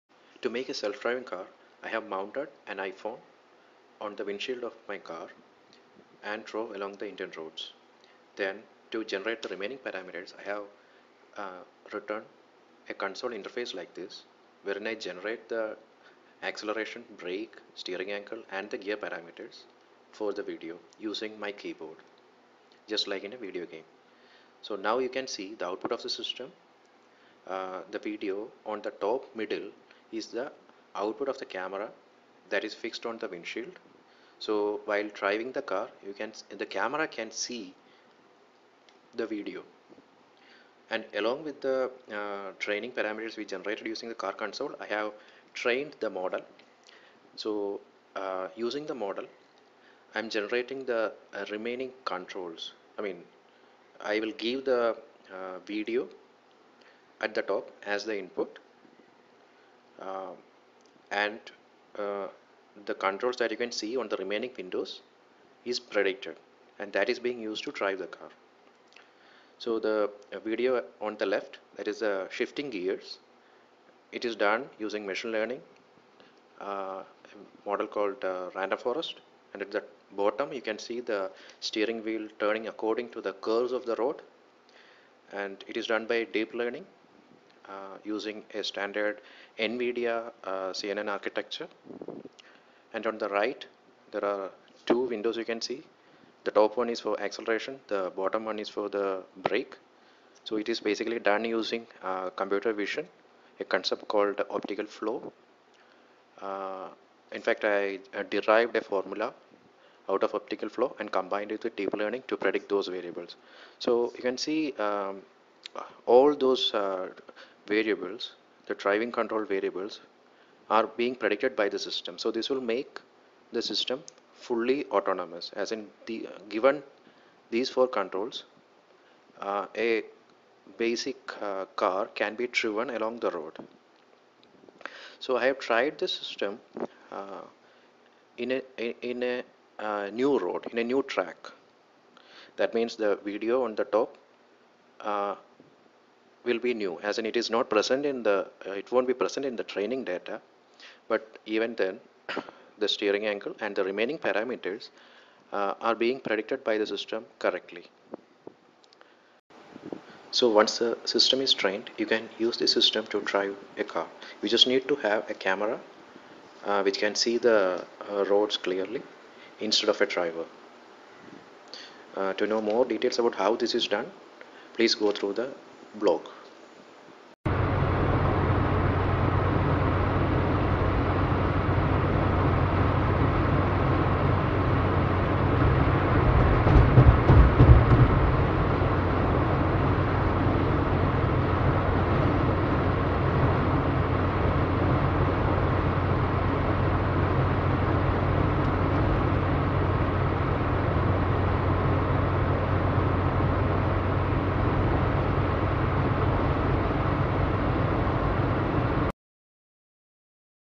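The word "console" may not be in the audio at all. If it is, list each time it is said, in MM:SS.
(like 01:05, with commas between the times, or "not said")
00:12, 00:44.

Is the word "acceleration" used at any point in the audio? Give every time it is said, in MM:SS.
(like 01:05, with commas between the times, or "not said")
00:16, 01:37.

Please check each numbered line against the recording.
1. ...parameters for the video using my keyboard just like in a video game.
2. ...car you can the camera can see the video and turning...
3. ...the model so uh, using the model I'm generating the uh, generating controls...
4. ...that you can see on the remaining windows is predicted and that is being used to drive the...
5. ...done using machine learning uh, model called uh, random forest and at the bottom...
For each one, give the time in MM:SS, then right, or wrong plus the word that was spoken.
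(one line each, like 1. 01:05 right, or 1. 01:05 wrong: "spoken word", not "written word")
1. 00:18 right
2. 00:35 wrong: "along", not "turning"
3. 00:45 wrong: "remaining", not "generating"
4. 01:03 right
5. 01:14 right.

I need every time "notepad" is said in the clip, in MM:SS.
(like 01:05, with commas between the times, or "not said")
not said.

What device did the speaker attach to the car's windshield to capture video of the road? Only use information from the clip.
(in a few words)
iPhone.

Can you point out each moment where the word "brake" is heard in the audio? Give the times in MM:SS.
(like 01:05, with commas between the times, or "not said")
00:17, 01:39.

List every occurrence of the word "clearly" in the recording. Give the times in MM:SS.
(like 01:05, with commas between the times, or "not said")
02:48.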